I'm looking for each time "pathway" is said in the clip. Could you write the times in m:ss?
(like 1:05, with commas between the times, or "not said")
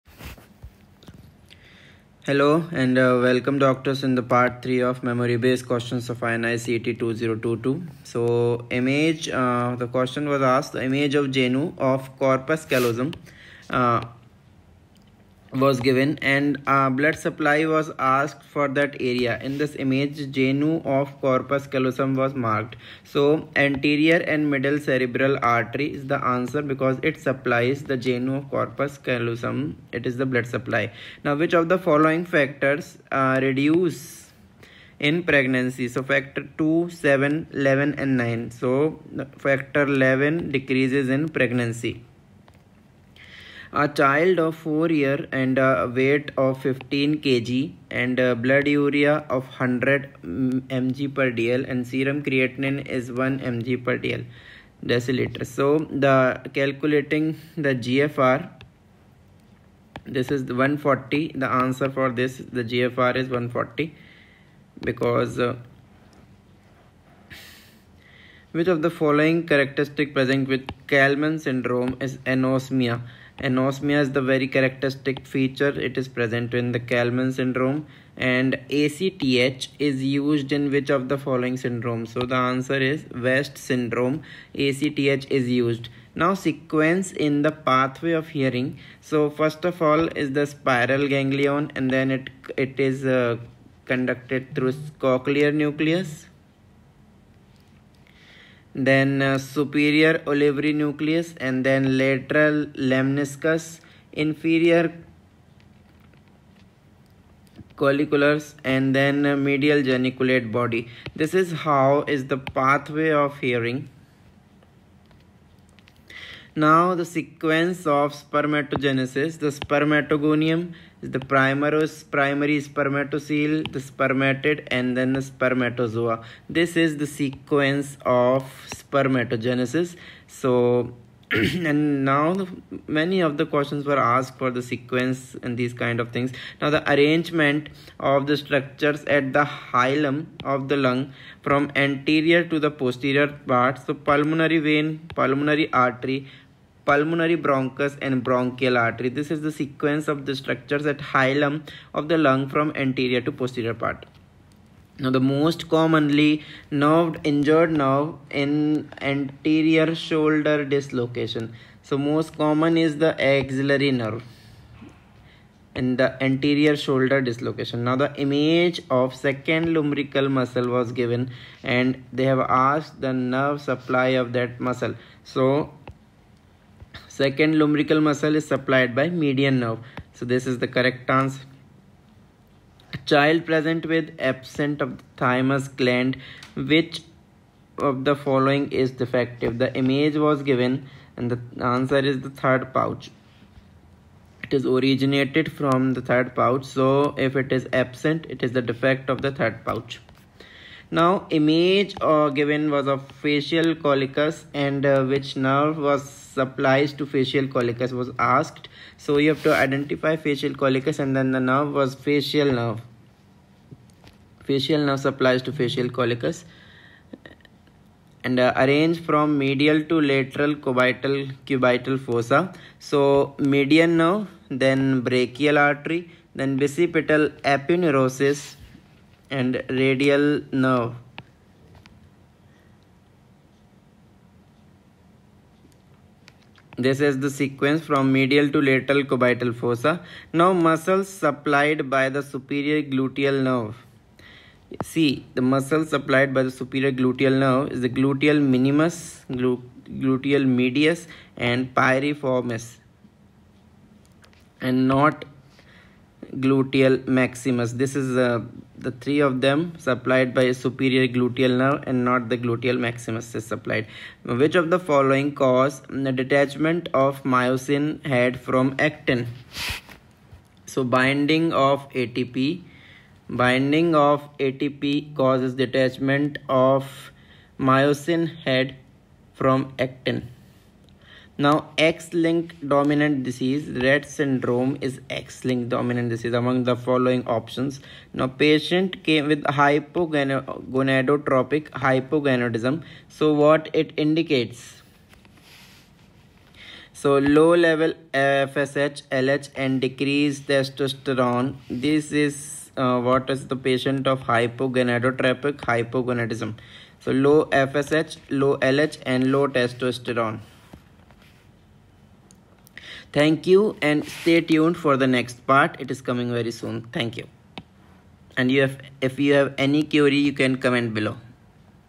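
1:27, 1:52.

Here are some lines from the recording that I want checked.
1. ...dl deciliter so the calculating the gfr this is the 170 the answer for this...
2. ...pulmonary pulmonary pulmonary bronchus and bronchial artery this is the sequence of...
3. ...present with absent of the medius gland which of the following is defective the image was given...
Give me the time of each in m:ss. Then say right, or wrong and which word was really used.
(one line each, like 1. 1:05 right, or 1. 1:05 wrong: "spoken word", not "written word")
1. 0:54 wrong: "140", not "170"
2. 2:25 wrong: "artery", not "pulmonary"
3. 3:03 wrong: "thymus", not "medius".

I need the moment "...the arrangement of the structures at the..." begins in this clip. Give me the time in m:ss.
2:16.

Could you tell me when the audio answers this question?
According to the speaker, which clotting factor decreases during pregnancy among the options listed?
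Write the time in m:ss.
0:39.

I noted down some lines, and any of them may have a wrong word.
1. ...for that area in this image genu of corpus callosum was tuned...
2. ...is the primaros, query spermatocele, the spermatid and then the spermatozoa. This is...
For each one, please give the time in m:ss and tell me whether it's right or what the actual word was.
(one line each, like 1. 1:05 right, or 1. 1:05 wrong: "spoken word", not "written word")
1. 0:18 wrong: "marked", not "tuned"
2. 2:01 wrong: "primary", not "query".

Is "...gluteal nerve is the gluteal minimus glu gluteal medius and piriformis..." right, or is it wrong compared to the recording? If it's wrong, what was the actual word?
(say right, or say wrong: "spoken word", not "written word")
right.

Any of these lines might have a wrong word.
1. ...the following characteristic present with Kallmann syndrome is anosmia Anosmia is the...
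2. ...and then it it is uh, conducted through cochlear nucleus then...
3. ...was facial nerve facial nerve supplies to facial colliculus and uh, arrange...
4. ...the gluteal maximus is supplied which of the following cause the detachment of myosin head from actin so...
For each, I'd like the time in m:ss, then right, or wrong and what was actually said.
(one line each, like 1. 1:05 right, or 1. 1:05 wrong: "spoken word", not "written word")
1. 1:08 right
2. 1:31 right
3. 3:31 right
4. 4:22 right.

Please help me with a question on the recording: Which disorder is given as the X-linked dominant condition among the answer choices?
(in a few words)
Rett syndrome.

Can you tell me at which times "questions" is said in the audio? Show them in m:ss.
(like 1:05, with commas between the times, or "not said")
0:05, 0:09, 2:13.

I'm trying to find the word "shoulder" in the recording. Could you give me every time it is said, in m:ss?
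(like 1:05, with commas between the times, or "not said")
2:39, 2:46.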